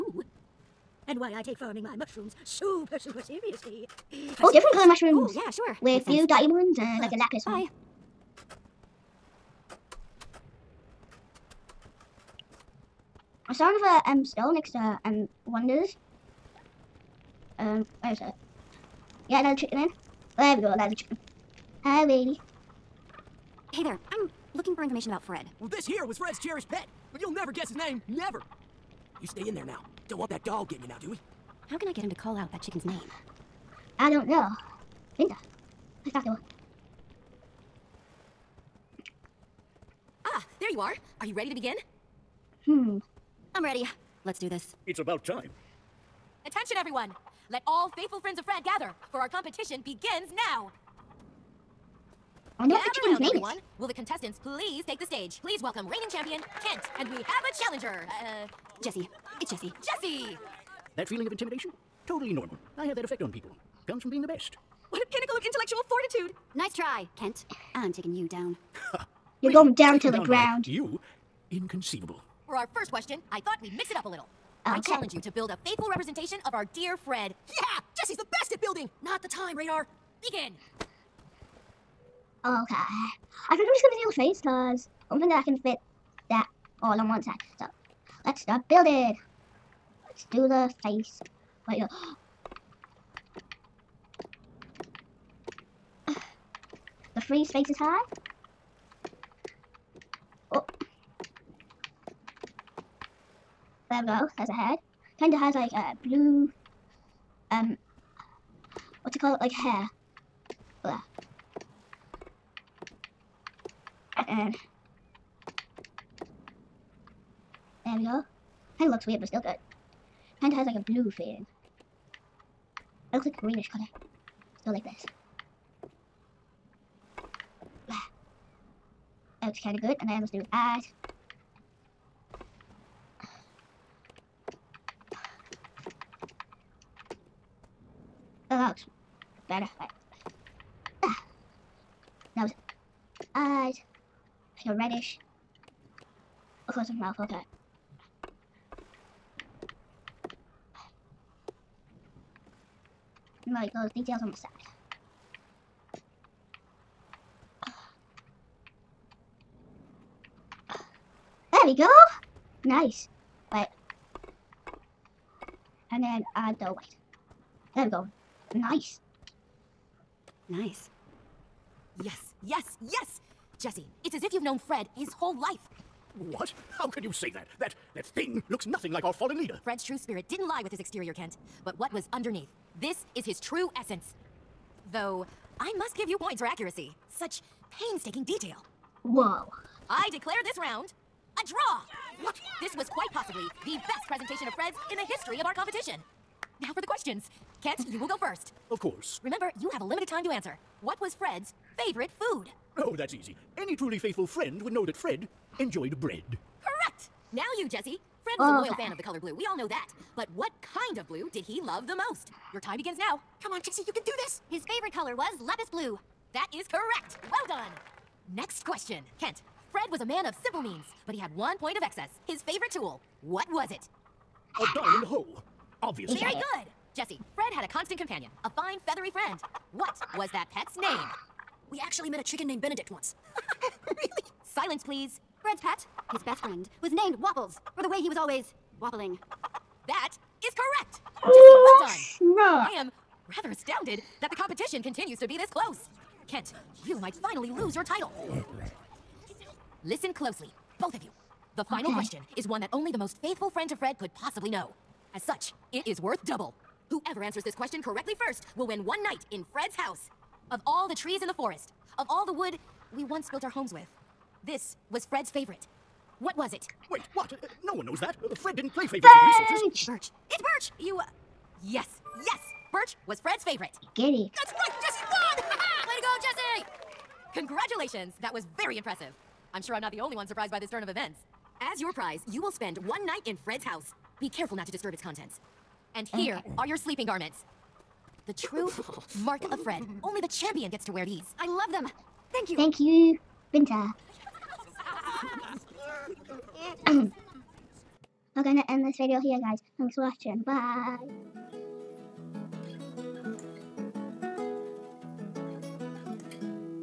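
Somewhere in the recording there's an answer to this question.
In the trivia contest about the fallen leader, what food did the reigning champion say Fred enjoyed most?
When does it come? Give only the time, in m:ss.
3:26.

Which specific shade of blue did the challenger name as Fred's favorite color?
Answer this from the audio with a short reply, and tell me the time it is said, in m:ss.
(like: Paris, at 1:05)
Lapis blue, at 3:35.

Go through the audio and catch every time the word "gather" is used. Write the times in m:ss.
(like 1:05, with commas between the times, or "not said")
0:48, 0:52.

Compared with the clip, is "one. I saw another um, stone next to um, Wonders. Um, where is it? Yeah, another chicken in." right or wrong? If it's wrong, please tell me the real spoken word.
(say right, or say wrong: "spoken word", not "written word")
right.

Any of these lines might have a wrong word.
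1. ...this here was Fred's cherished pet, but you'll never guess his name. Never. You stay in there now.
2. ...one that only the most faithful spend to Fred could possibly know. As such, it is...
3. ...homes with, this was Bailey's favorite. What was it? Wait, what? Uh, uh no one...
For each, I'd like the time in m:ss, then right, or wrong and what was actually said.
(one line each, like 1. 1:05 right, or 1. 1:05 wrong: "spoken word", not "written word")
1. 0:25 right
2. 4:12 wrong: "friend", not "spend"
3. 4:23 wrong: "Fred", not "Bailey".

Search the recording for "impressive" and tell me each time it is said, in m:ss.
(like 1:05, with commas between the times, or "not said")
4:38.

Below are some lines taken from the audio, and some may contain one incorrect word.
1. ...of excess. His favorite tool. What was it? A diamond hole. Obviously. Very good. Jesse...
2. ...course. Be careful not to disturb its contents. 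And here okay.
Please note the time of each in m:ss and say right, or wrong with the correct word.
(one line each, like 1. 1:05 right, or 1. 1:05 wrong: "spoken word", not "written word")
1. 3:41 right
2. 4:43 wrong: "house", not "course".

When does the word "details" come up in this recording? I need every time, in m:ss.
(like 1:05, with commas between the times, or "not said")
2:33, 3:08.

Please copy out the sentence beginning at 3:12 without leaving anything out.
This was quite possibly the best presentation of Fred's in the history of our competition.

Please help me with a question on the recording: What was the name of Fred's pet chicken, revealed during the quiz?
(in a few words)
Waffles.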